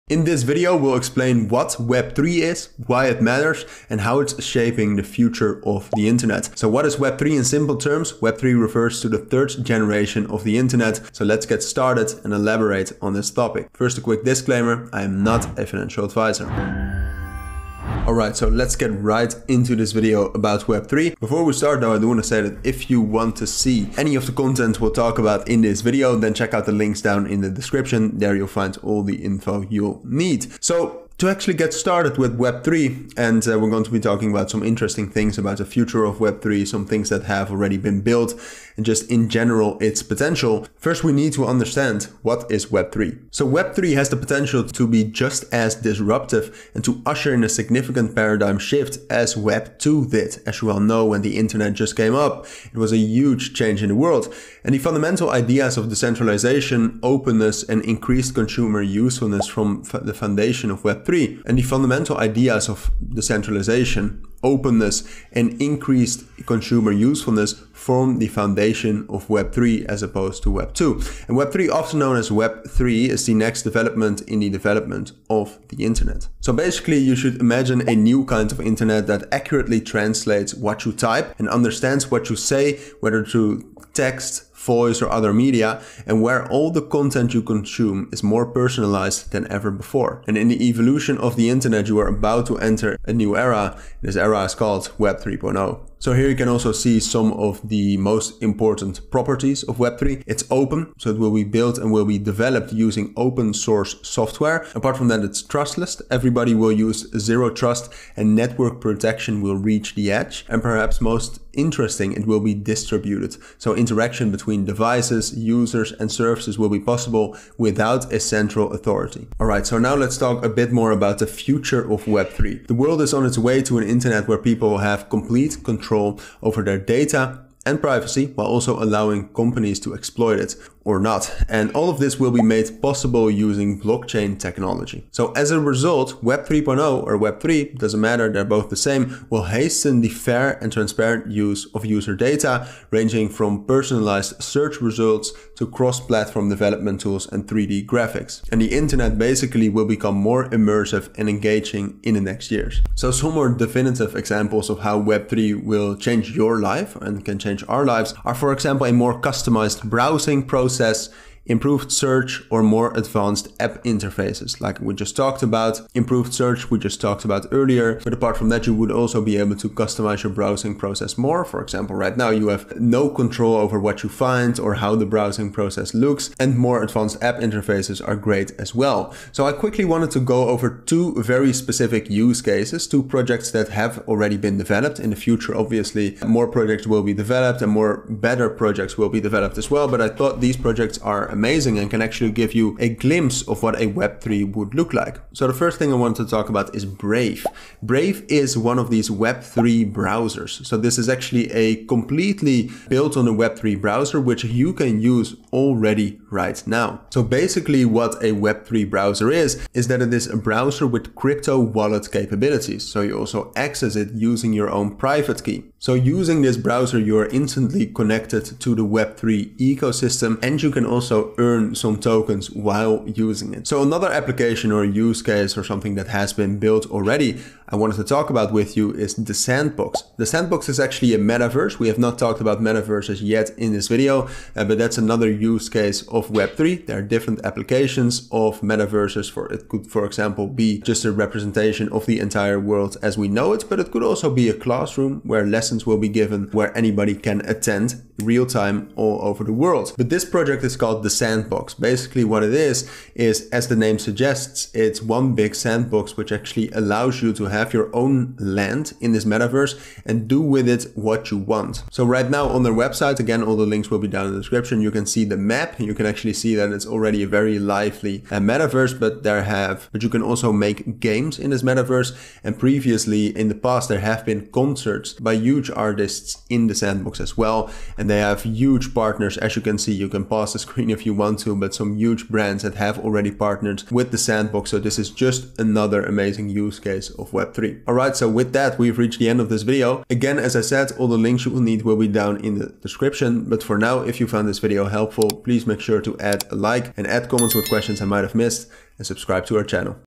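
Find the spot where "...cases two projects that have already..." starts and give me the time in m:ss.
3:02.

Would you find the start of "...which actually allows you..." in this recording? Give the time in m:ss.
4:16.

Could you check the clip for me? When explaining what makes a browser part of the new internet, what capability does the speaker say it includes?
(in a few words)
Crypto wallet capabilities.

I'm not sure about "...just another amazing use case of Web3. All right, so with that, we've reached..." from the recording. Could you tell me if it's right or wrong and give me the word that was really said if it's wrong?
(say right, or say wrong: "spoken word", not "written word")
right.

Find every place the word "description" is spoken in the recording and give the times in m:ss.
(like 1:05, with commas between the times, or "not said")
0:27, 4:24, 4:52.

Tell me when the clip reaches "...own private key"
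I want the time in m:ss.
3:34.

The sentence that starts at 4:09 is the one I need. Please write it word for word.
But this project is called the sandbox.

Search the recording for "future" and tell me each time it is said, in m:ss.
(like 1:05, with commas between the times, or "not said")
0:05, 0:35, 2:01, 3:05.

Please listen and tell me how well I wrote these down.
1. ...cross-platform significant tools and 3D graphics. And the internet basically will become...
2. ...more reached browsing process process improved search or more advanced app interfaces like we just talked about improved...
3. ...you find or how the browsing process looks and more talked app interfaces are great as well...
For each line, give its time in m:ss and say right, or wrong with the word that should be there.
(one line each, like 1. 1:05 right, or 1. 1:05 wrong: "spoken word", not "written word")
1. 2:25 wrong: "development", not "significant"
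2. 2:38 wrong: "customized", not "reached"
3. 2:54 wrong: "advanced", not "talked".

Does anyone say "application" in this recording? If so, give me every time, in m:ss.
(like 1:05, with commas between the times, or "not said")
3:44, 3:57.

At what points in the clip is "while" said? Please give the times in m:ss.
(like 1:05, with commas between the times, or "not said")
2:08, 3:42.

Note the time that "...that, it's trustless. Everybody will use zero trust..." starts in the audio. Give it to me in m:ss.
1:45.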